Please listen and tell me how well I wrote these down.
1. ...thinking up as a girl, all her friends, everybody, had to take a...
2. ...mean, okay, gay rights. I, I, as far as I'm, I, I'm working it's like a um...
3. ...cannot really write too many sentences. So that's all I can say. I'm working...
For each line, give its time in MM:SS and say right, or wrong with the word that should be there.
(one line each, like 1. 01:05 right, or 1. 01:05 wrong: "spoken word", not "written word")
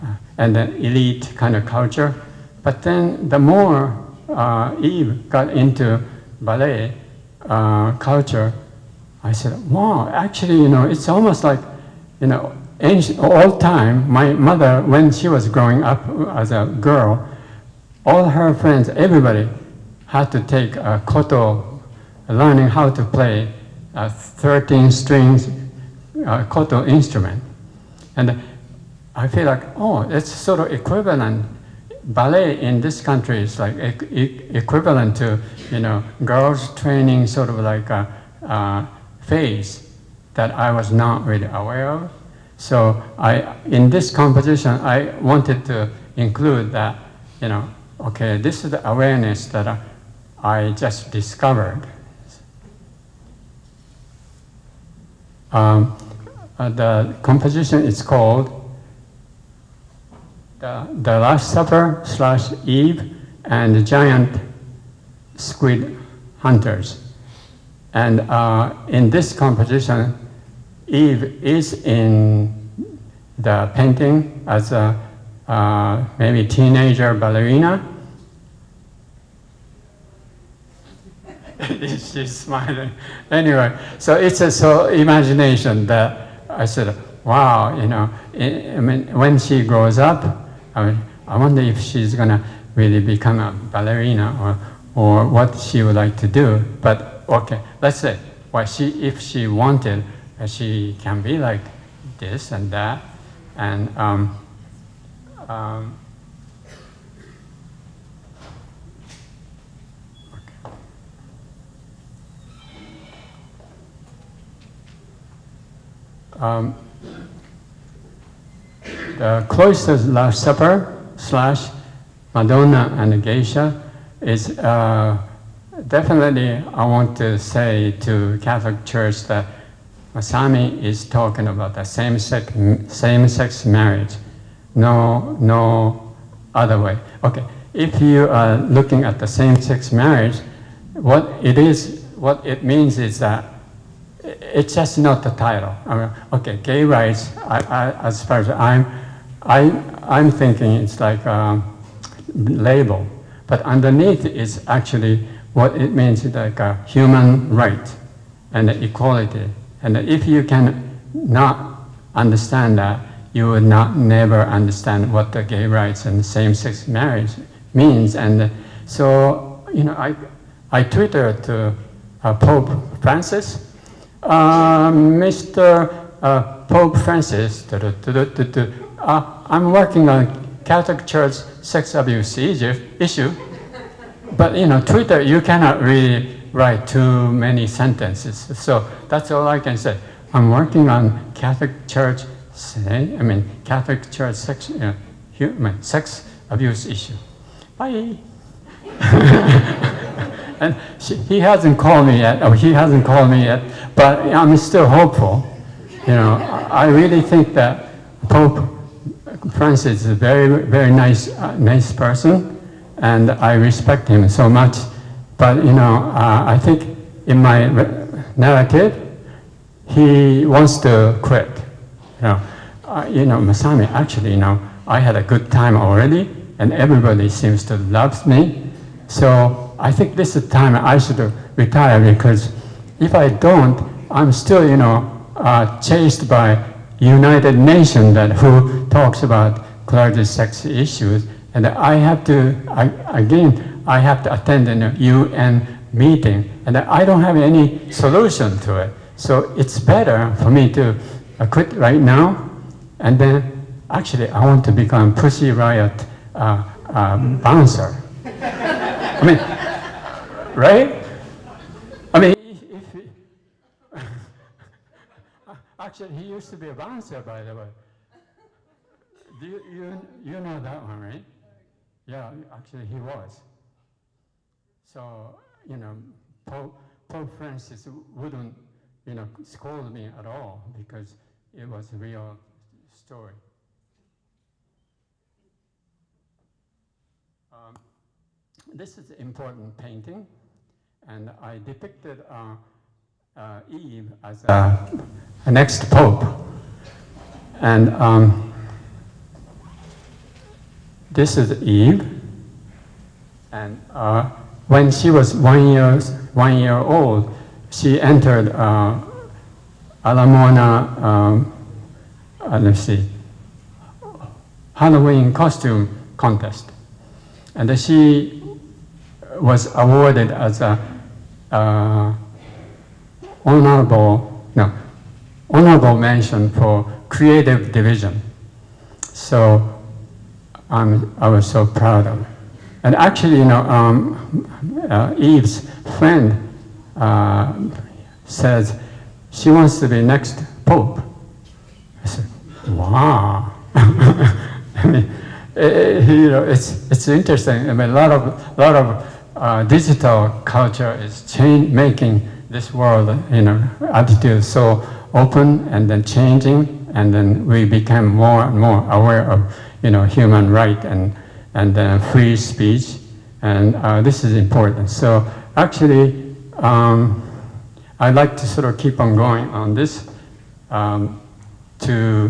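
1. 00:15 wrong: "growing", not "thinking"
2. 02:25 wrong: "thinking", not "working"
3. 03:05 right.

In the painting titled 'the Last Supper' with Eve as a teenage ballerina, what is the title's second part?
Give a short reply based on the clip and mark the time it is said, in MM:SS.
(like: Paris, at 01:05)
Eve and the Giant Squid Hunters, at 01:02.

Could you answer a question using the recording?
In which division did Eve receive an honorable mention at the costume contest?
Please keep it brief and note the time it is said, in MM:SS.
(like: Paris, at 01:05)
Creative division, at 05:27.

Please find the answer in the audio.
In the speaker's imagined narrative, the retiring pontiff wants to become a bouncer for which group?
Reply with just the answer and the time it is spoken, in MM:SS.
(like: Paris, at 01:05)
Pussy Riot, at 04:15.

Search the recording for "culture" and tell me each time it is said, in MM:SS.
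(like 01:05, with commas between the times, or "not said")
00:01, 00:07, 05:50.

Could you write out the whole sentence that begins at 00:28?
And I feel like, oh, it's sort of equivalent.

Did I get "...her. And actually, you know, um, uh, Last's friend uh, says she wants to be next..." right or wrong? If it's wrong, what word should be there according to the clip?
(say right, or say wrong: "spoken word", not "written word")
wrong: "Eve", not "Last".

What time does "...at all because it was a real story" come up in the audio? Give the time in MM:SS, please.
04:40.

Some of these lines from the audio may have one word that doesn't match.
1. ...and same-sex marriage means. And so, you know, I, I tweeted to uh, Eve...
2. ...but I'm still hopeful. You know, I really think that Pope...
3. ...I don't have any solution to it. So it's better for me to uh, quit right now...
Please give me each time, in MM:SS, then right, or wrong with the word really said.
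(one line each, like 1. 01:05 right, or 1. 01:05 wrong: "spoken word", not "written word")
1. 02:46 wrong: "Pope", not "Eve"
2. 03:23 right
3. 04:06 right.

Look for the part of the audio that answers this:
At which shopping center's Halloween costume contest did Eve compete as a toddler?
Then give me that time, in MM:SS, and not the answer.
05:10.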